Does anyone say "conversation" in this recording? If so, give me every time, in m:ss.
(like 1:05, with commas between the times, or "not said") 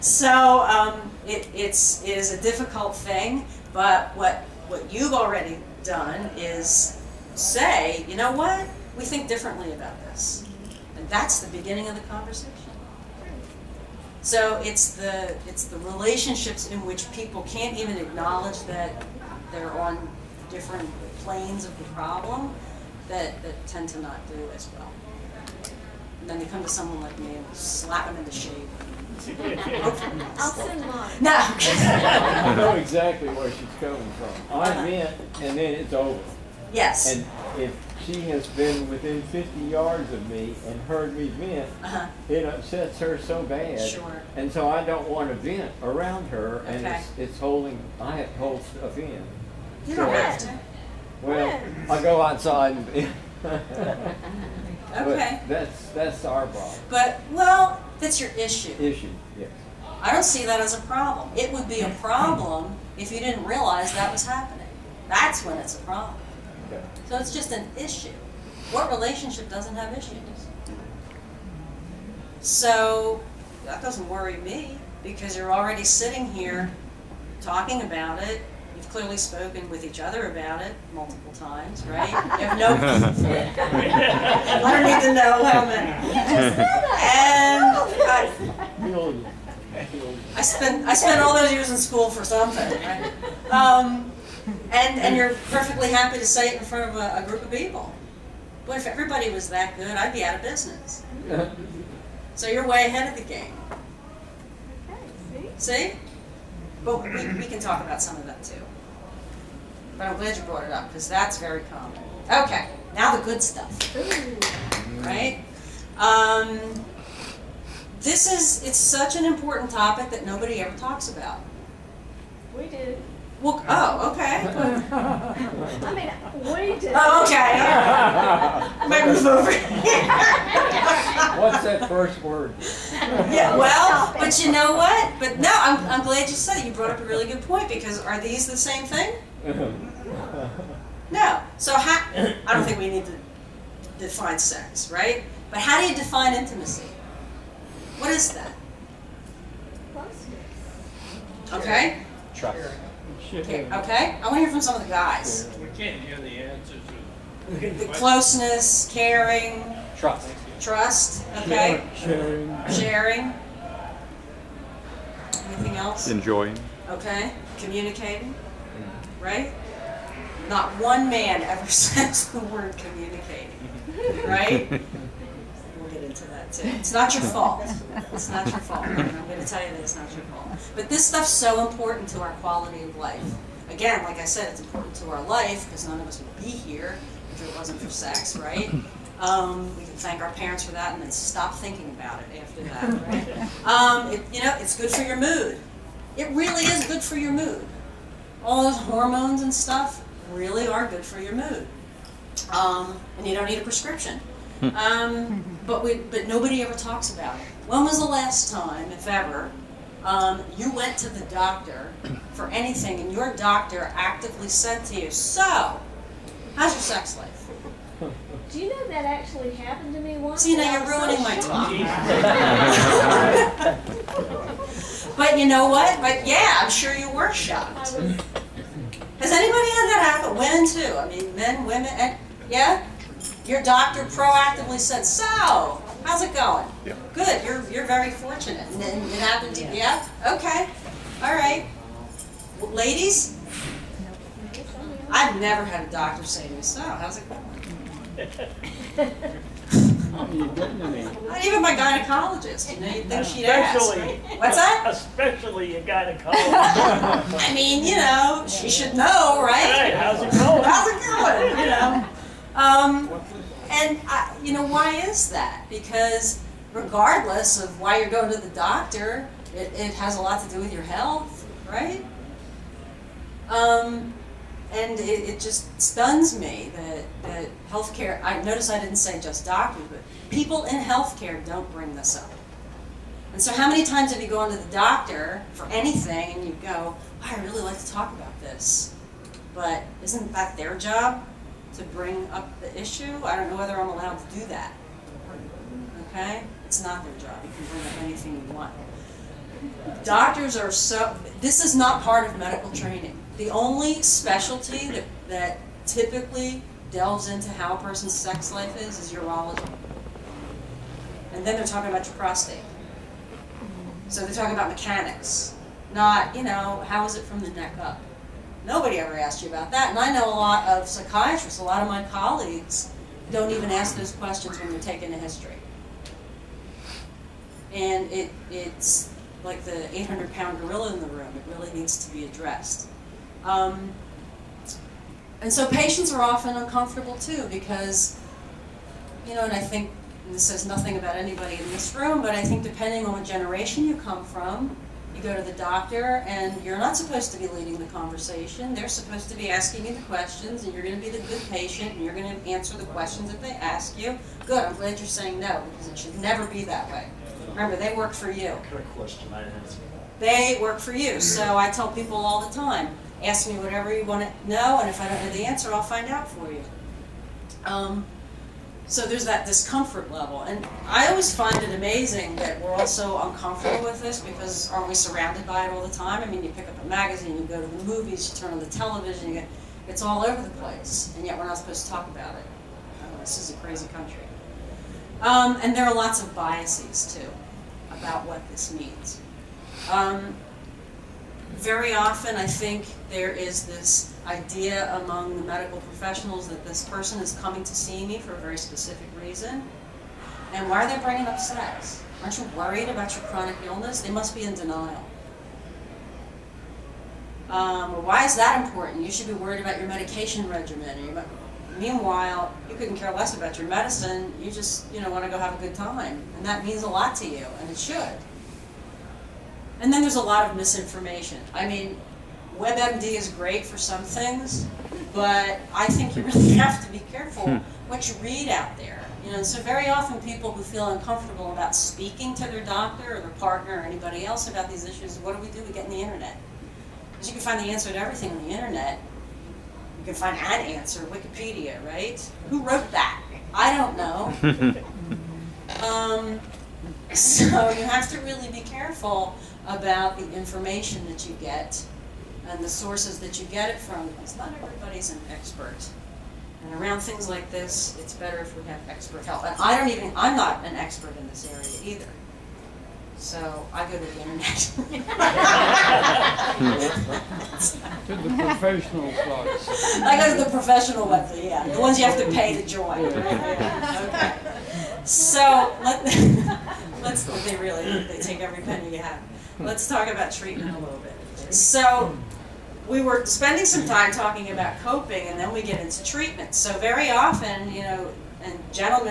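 0:12, 5:47.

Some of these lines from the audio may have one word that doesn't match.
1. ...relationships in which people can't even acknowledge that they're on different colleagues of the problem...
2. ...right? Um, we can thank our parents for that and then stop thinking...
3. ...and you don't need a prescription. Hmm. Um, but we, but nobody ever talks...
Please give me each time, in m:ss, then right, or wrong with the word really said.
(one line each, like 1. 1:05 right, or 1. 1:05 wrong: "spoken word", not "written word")
1. 0:15 wrong: "planes", not "colleagues"
2. 3:08 right
3. 3:23 right.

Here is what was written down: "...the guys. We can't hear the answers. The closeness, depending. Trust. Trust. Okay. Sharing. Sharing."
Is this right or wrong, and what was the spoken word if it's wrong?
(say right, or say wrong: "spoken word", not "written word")
wrong: "caring", not "depending".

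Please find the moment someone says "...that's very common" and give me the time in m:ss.
1:51.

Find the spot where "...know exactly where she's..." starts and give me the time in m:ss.
0:32.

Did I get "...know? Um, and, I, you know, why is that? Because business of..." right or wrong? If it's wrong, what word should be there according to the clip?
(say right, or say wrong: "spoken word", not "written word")
wrong: "regardless", not "business".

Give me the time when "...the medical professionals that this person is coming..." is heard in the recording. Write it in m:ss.
6:35.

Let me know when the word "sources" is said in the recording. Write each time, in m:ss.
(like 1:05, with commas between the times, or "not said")
7:32.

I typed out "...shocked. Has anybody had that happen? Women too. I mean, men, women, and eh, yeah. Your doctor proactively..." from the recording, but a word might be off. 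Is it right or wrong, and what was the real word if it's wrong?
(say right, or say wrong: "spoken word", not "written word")
right.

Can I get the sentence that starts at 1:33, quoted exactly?
Um, and and you're perfectly happy to say it in front of a, a group of people.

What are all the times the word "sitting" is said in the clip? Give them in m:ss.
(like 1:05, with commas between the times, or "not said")
1:15.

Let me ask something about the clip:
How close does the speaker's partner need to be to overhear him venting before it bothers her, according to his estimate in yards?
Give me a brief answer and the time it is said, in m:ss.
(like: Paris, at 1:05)
50 yards, at 0:39.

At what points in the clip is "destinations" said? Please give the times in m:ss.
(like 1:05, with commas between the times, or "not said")
not said.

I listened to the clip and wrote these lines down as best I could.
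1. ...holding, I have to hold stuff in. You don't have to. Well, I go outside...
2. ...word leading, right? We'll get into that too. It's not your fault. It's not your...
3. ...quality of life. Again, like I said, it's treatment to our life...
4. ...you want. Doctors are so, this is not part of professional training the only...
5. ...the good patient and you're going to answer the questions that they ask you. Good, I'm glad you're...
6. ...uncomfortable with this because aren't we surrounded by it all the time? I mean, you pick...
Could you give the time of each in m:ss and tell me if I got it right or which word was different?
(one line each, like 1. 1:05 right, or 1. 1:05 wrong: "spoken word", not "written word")
1. 0:47 right
2. 2:52 wrong: "communicating", not "leading"
3. 3:02 wrong: "important", not "treatment"
4. 4:58 wrong: "medical", not "professional"
5. 5:51 right
6. 6:13 right.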